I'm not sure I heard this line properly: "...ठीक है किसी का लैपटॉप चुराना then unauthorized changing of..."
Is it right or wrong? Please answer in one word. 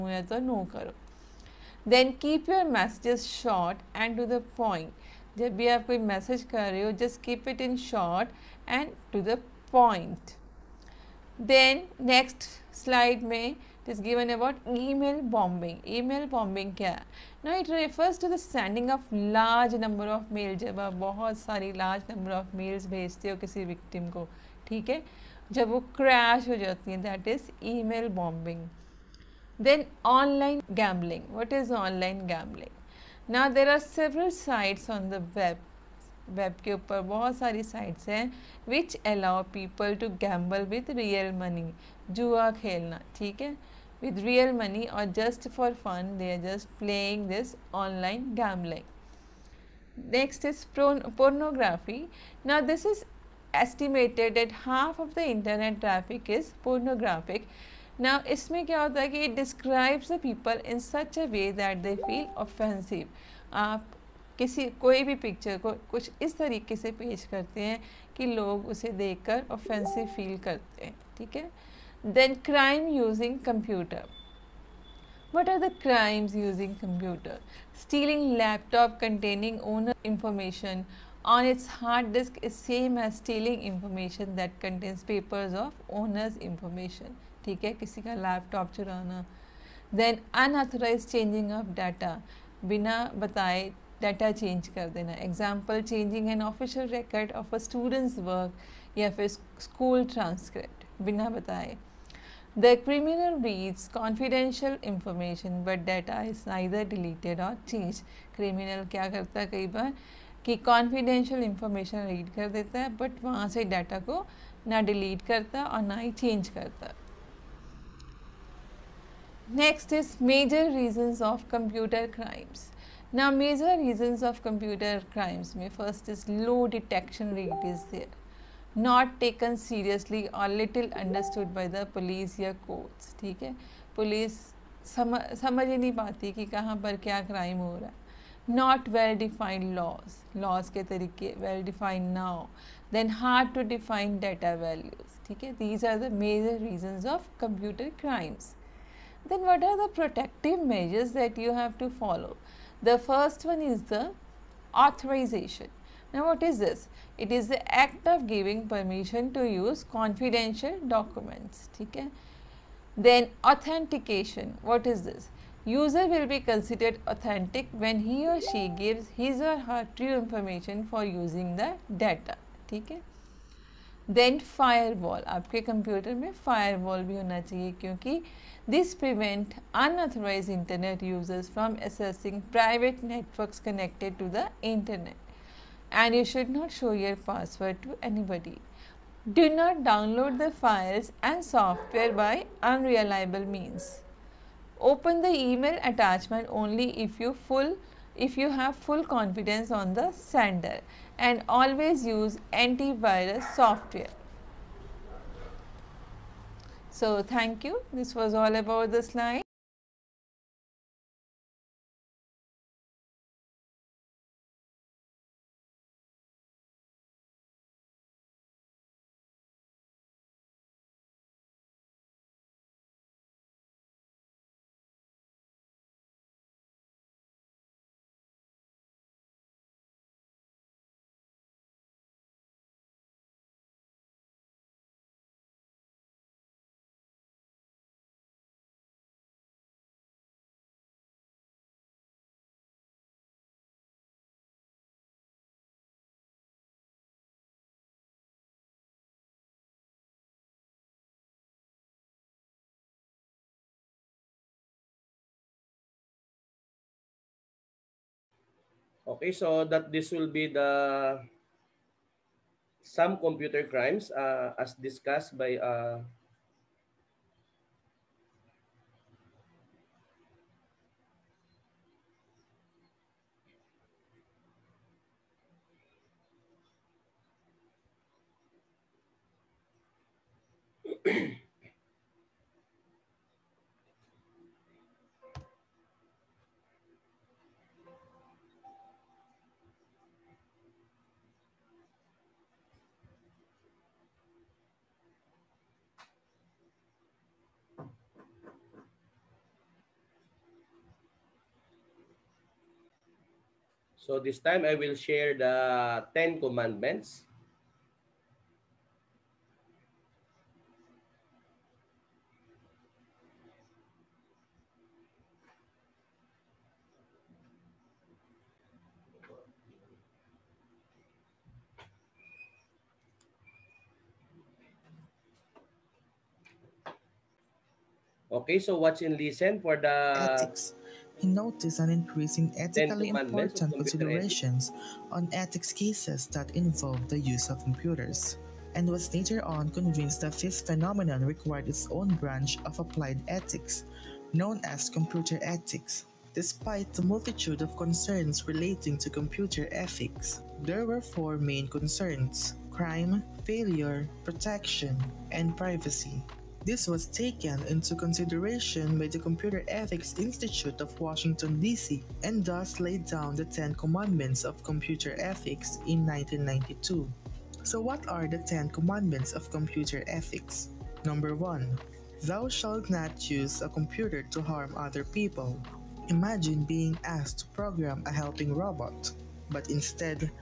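right.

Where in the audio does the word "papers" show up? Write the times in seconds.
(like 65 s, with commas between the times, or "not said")
85 s.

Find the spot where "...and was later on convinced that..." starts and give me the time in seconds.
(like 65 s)
338 s.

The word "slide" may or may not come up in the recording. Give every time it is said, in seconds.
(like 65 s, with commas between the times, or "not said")
209 s.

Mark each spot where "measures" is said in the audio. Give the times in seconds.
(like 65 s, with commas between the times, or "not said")
150 s.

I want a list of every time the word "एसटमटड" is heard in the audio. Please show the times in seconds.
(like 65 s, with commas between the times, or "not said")
53 s.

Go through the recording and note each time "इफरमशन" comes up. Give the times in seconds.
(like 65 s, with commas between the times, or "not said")
80 s, 111 s.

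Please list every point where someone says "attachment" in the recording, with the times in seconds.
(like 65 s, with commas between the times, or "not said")
195 s.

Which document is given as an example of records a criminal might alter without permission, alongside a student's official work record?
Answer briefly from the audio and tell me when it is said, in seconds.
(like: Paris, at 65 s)
School transcript, at 99 s.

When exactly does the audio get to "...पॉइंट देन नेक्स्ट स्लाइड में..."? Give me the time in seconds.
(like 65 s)
9 s.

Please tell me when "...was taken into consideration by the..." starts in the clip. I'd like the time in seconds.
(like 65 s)
356 s.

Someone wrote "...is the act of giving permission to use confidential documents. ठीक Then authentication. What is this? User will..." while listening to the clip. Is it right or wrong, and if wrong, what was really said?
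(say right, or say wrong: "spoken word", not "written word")
right.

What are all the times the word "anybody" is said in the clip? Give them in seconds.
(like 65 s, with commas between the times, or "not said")
188 s.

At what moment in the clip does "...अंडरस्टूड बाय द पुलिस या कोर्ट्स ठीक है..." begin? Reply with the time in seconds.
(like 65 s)
130 s.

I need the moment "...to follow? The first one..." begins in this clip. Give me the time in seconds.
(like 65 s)
151 s.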